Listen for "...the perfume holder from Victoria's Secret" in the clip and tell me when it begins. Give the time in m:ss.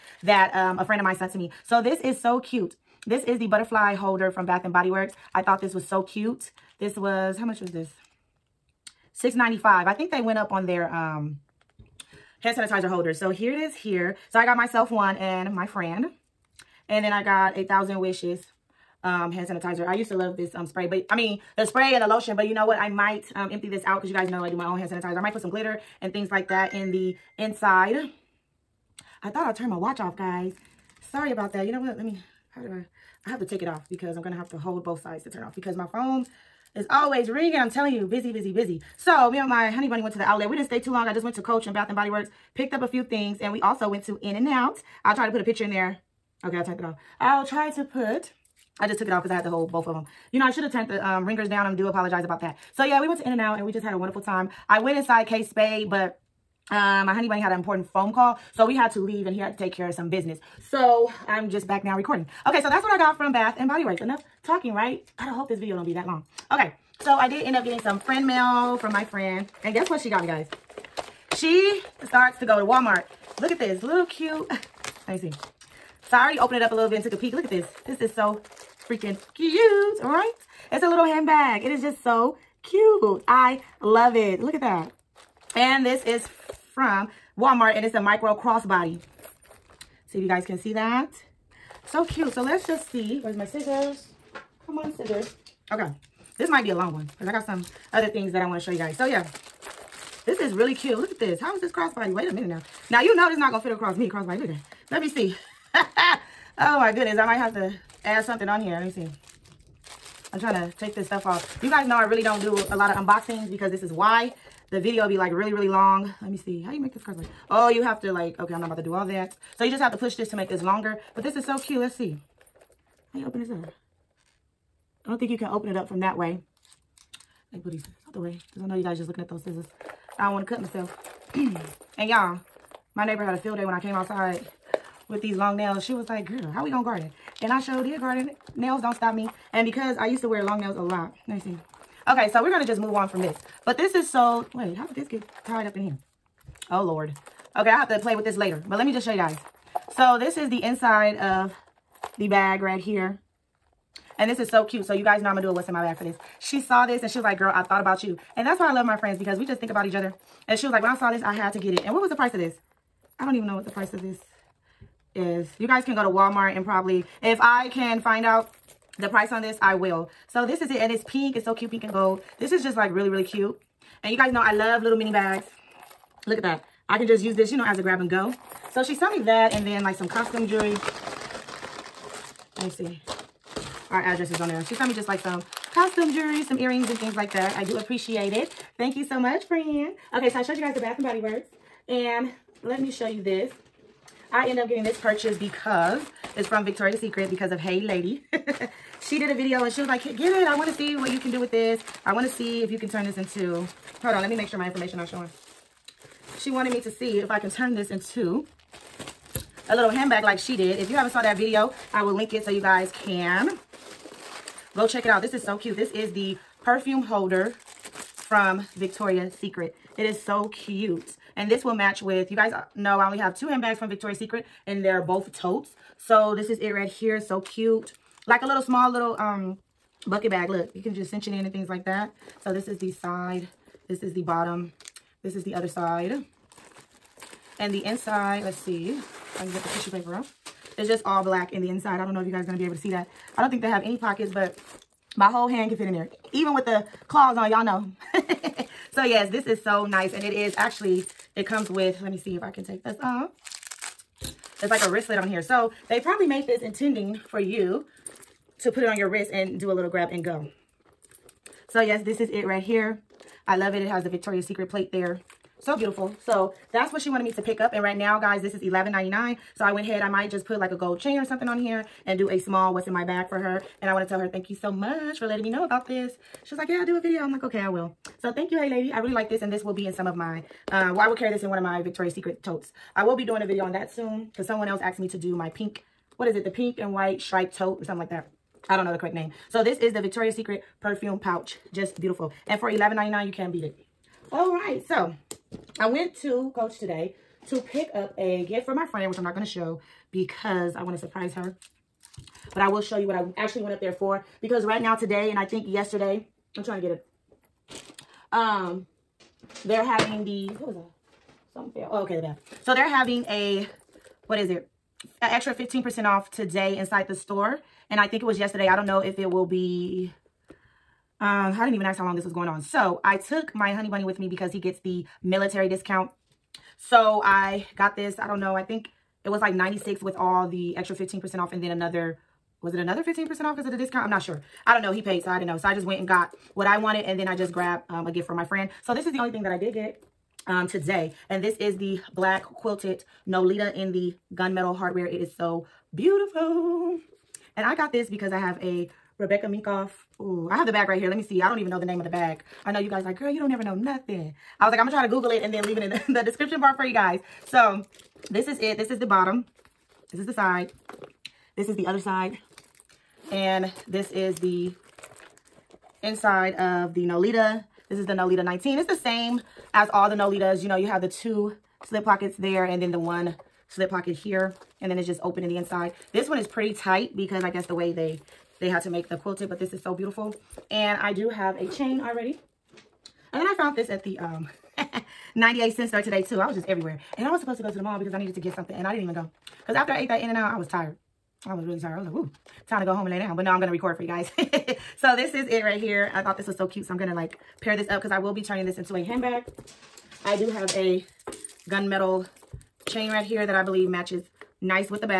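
3:36.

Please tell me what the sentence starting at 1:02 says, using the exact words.
Okay, so that's what I got from Bath and Body Works.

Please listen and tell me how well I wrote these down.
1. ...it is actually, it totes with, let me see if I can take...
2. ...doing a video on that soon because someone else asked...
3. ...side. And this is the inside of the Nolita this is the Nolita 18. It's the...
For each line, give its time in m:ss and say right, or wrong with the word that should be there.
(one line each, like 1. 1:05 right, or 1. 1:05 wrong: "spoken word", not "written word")
1. 4:10 wrong: "comes", not "totes"
2. 4:43 right
3. 6:01 wrong: "19", not "18".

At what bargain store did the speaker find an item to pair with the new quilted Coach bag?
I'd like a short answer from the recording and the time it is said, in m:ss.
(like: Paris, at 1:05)
98 cents store, at 6:25.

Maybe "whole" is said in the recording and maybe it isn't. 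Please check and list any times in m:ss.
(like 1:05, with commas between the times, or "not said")
0:49, 4:05.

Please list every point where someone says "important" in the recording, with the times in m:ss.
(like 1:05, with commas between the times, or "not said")
0:57.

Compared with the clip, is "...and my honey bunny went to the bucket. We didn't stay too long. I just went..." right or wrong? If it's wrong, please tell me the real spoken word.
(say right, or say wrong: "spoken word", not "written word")
wrong: "outlet", not "bucket".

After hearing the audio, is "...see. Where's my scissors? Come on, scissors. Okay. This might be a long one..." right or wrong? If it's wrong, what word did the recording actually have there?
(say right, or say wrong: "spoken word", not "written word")
right.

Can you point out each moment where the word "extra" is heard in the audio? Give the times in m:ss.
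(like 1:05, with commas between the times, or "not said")
5:15, 5:30.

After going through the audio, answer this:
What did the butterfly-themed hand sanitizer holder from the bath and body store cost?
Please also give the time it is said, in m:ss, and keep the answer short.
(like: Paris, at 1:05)
$6.95, at 0:09.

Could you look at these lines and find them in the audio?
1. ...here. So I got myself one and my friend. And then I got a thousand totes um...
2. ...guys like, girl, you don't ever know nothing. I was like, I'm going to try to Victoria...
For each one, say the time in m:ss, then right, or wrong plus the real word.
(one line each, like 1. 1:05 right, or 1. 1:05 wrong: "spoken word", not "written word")
1. 0:13 wrong: "wishes", not "totes"
2. 5:52 wrong: "Google", not "Victoria".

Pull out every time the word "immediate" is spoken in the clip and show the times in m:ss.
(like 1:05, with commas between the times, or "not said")
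not said.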